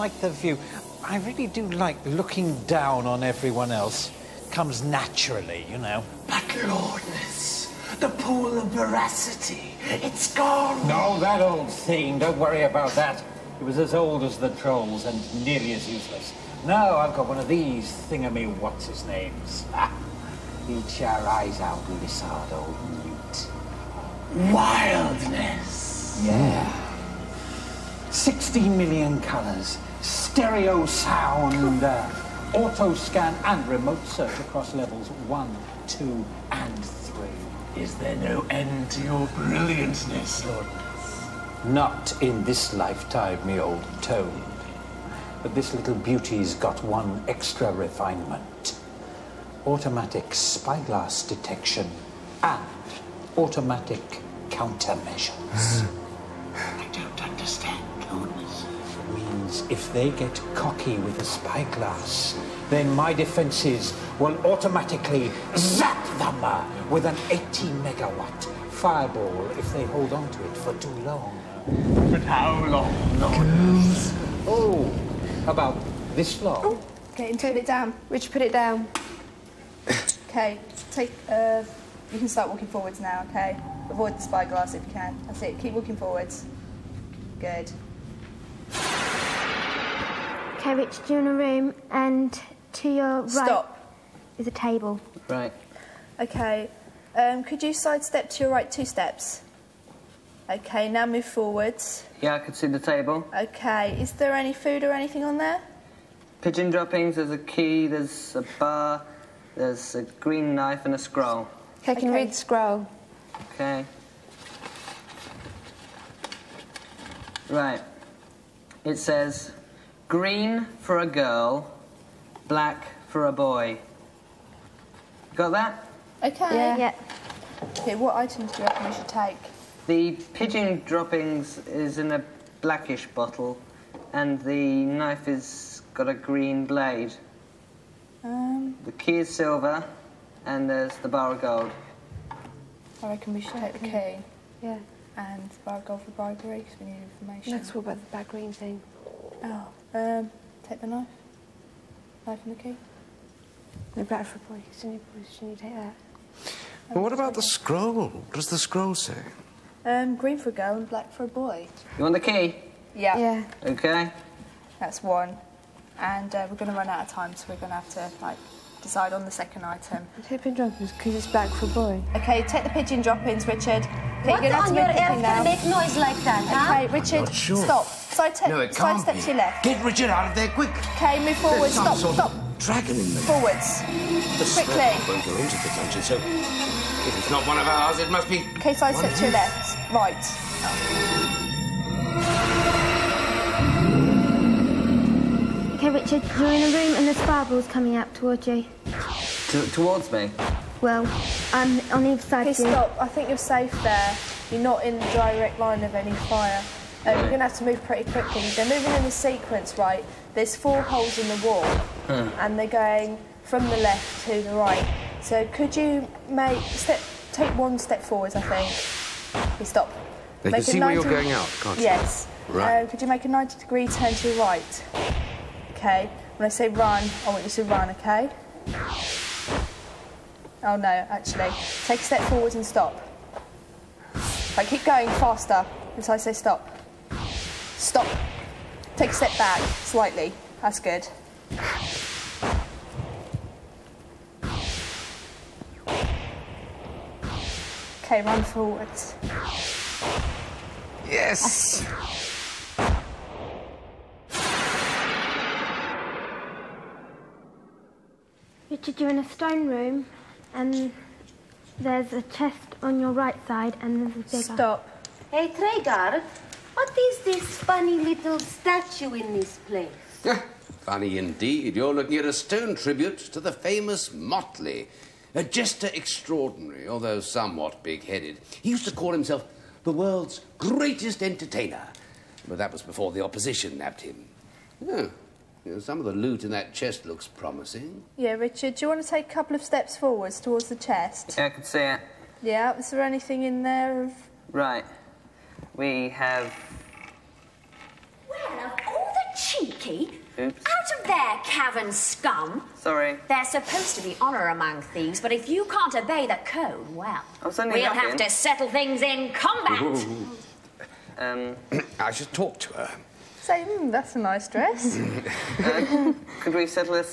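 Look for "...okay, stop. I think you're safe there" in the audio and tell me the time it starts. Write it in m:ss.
3:22.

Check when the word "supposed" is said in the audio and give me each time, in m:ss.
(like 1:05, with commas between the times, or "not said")
5:03.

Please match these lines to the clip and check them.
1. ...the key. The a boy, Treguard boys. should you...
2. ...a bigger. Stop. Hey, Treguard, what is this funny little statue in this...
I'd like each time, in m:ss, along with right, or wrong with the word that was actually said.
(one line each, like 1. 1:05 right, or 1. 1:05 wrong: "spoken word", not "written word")
1. 2:32 wrong: "Sydney", not "Treguard"
2. 4:24 right.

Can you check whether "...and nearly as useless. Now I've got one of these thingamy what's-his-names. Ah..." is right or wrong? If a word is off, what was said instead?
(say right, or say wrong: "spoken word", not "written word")
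right.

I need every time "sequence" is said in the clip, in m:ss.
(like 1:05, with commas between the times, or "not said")
3:29.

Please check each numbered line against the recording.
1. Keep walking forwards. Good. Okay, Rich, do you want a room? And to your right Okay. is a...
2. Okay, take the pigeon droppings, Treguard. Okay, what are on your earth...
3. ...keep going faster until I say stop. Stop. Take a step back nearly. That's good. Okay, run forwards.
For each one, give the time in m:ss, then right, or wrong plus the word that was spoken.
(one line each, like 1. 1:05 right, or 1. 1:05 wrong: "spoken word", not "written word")
1. 1:25 wrong: "Stop", not "Okay"
2. 2:52 wrong: "Richard", not "Treguard"
3. 3:54 wrong: "slightly", not "nearly".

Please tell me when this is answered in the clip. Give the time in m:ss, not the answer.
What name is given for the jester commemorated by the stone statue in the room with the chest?
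4:34.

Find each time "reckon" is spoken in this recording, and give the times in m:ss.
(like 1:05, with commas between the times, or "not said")
2:08, 2:23.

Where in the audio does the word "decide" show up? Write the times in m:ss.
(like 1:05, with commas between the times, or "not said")
2:48.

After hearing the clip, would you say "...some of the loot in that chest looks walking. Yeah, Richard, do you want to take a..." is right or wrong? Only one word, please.
wrong.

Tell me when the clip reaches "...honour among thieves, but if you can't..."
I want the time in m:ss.
5:04.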